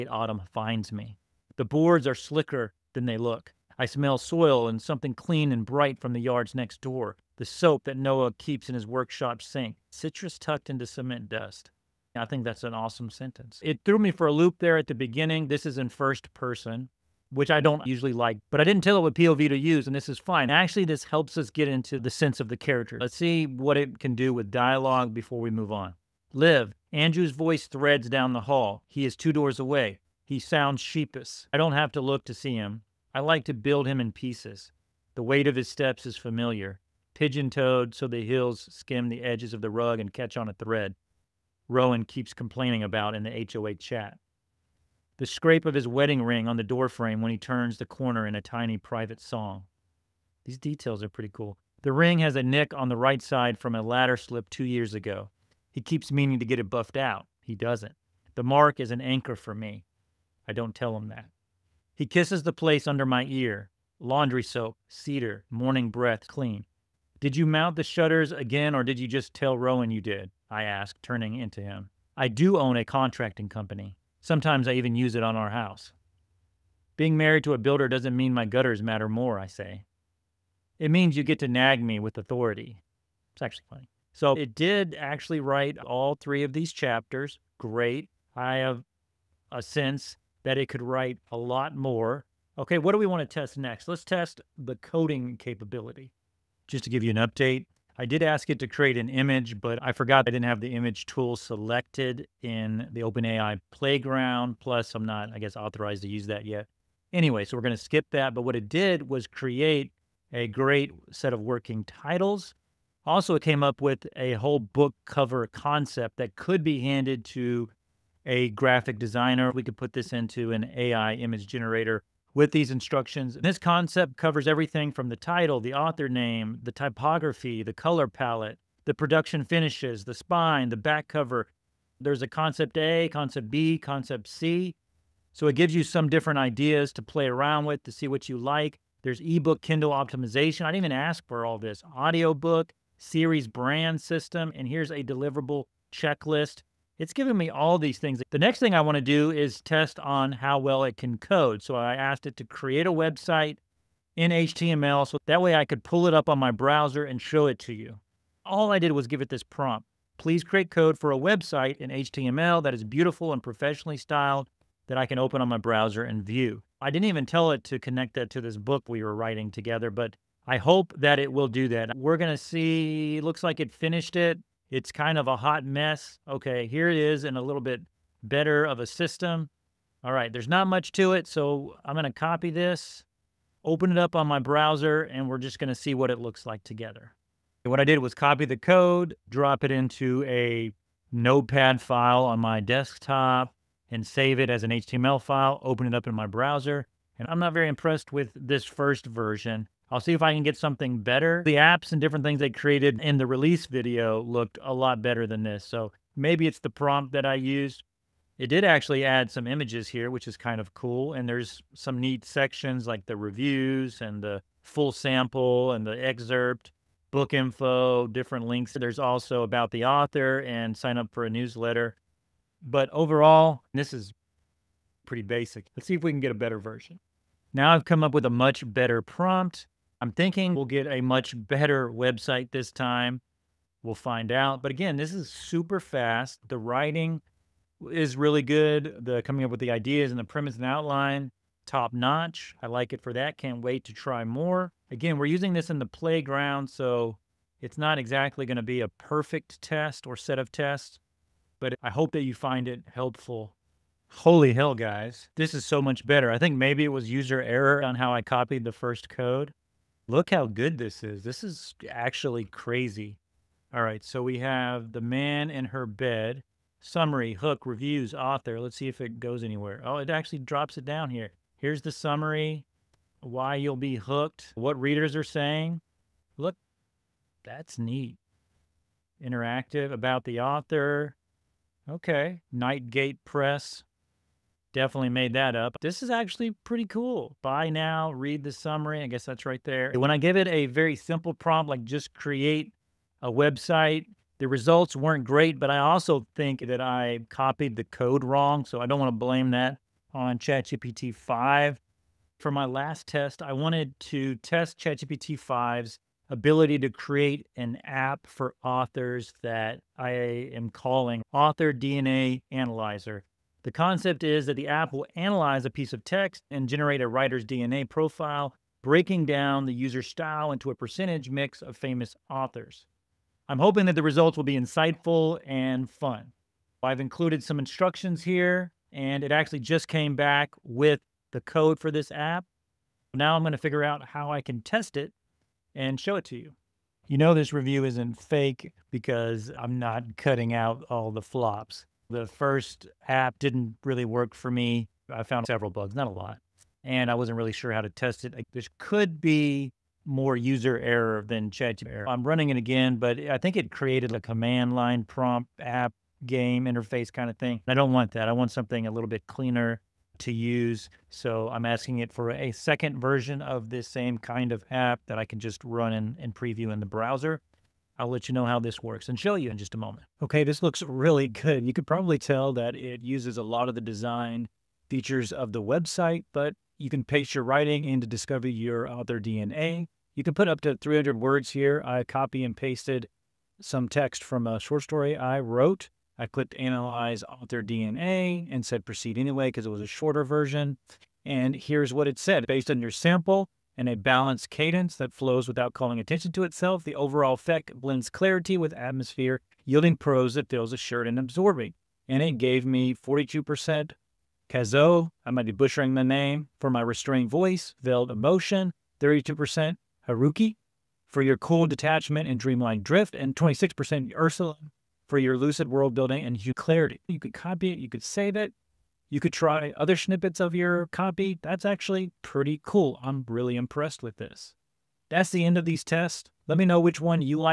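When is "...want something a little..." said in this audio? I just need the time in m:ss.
5:58.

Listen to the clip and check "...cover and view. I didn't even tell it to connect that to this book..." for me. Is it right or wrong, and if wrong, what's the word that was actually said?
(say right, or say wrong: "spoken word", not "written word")
wrong: "browser", not "cover".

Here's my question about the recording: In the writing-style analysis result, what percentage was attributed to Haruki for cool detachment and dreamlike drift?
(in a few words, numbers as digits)
32%.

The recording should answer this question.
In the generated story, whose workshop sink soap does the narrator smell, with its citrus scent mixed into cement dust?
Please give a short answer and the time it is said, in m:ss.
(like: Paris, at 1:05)
Noah, at 0:07.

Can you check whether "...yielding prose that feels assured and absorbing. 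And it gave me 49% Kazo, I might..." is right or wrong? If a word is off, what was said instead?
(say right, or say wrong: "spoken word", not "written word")
wrong: "42", not "49".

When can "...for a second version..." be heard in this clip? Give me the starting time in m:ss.
6:02.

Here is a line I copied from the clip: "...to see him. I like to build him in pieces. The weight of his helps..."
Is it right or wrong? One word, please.
wrong.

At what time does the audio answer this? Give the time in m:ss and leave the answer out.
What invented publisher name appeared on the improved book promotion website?
4:42.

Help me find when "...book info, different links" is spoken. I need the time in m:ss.
3:37.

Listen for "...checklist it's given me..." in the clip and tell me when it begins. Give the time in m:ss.
2:25.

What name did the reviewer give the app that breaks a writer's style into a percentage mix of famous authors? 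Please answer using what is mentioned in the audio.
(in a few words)
Author DNA Analyzer.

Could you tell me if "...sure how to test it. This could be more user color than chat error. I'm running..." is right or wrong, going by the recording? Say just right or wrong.
wrong.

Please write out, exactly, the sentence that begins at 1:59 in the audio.
We could put this into an AI image generator with these instructions.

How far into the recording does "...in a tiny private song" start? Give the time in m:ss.
0:48.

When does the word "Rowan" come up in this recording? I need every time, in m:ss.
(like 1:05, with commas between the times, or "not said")
0:41, 1:09.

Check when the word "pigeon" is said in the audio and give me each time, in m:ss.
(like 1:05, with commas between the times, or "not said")
0:37.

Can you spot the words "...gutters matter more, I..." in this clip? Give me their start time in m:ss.
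1:18.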